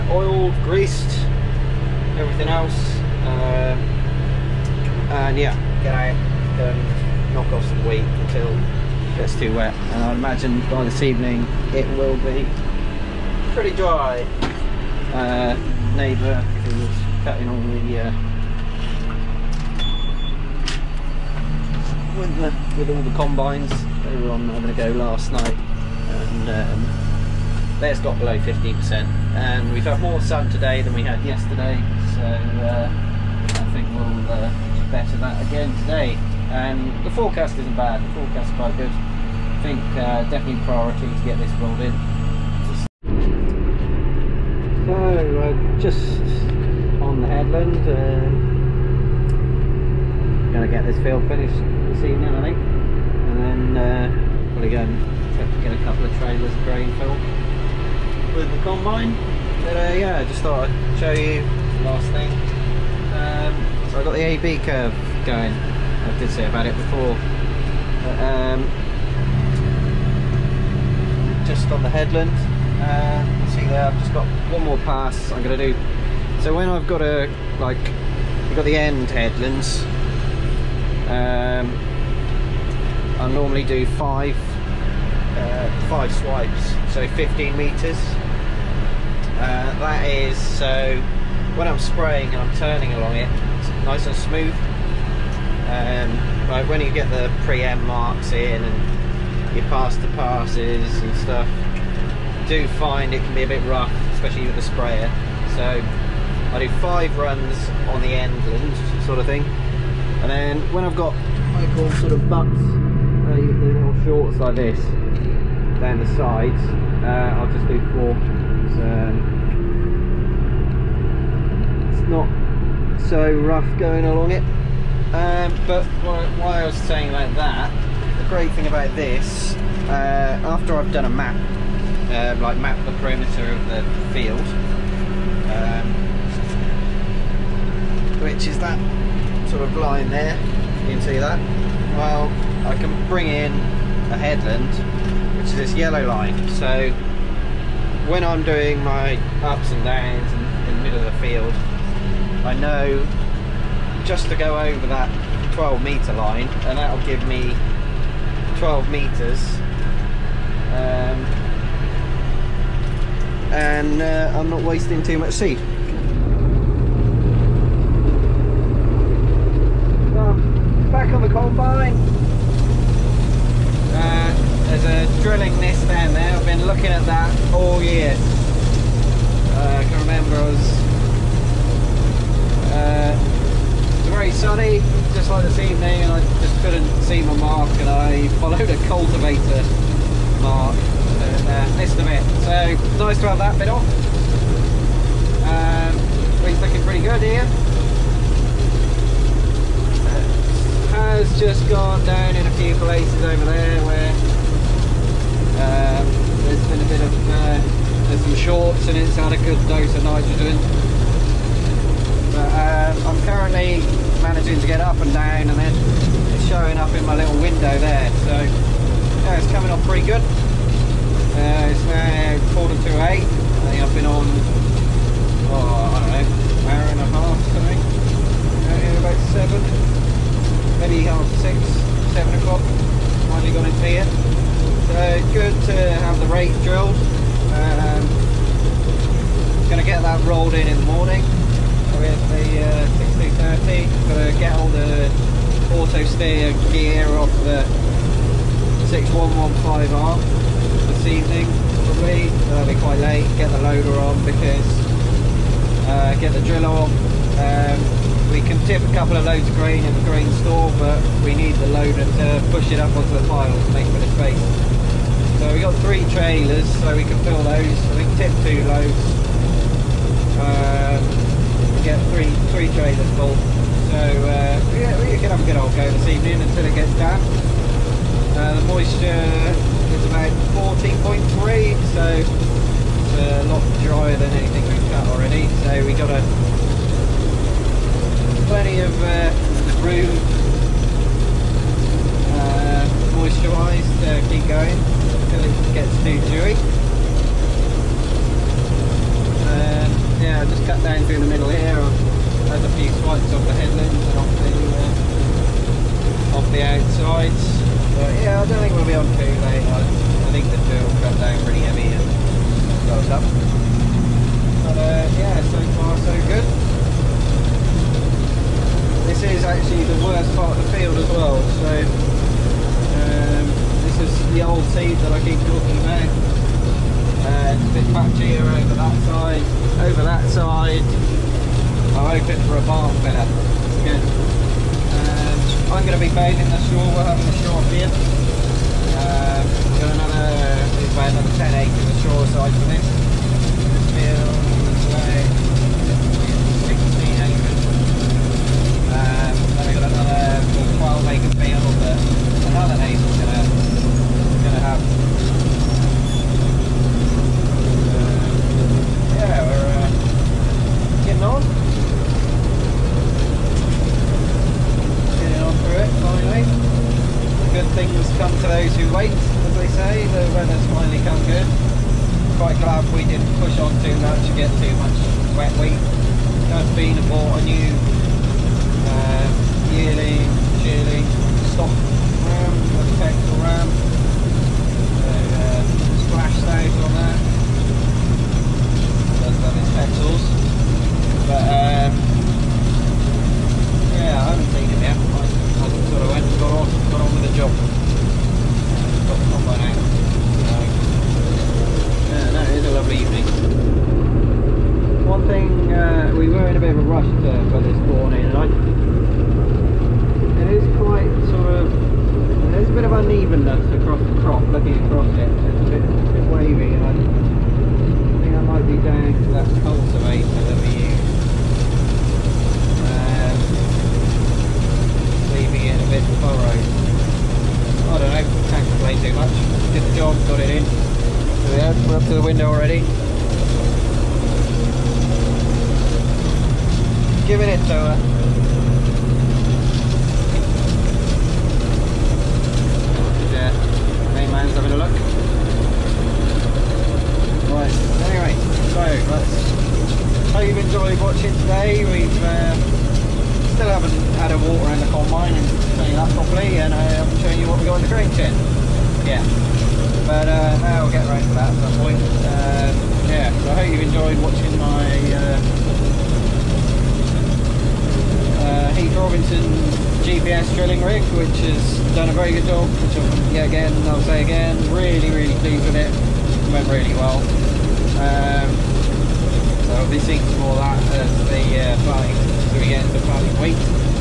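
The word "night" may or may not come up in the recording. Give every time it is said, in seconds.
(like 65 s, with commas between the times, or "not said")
25 s.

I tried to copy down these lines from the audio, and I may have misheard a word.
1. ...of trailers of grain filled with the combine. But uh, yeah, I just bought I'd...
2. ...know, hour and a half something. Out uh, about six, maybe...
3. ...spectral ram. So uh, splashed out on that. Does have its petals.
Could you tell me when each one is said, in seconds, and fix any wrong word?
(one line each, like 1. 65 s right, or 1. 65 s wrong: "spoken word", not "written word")
1. 56 s wrong: "thought", not "bought"
2. 226 s wrong: "seven", not "six"
3. 382 s right.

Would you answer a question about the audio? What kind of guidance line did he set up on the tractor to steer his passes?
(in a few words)
AB curve.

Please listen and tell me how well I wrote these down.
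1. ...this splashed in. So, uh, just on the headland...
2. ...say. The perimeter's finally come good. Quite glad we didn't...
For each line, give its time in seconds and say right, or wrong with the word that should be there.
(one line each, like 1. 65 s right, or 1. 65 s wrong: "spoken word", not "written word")
1. 41 s wrong: "rolled", not "splashed"
2. 369 s wrong: "weather", not "perimeter".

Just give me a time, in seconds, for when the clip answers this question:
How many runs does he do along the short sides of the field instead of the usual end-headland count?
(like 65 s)
117 s.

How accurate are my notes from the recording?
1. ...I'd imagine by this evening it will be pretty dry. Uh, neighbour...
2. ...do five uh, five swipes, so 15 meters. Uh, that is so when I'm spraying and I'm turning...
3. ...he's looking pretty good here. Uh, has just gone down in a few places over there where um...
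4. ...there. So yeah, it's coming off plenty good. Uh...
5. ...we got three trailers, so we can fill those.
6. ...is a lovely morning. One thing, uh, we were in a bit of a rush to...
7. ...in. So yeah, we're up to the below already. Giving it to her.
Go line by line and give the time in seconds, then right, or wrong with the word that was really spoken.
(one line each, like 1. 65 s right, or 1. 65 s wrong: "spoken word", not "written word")
1. 10 s right
2. 83 s right
3. 196 s right
4. 217 s wrong: "pretty", not "plenty"
5. 265 s right
6. 402 s wrong: "evening", not "morning"
7. 430 s wrong: "window", not "below".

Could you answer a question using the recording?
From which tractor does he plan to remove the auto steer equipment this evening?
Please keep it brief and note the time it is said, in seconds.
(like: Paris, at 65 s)
6115R, at 248 s.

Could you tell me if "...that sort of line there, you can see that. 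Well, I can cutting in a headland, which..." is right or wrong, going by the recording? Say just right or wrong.
wrong.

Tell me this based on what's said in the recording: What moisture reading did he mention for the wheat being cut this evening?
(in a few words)
14.3.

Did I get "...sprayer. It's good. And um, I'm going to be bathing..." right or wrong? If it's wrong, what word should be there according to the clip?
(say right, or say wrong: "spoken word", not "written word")
wrong: "filler", not "sprayer".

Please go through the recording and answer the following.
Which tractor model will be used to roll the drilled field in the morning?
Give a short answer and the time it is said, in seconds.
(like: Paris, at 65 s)
1630, at 243 s.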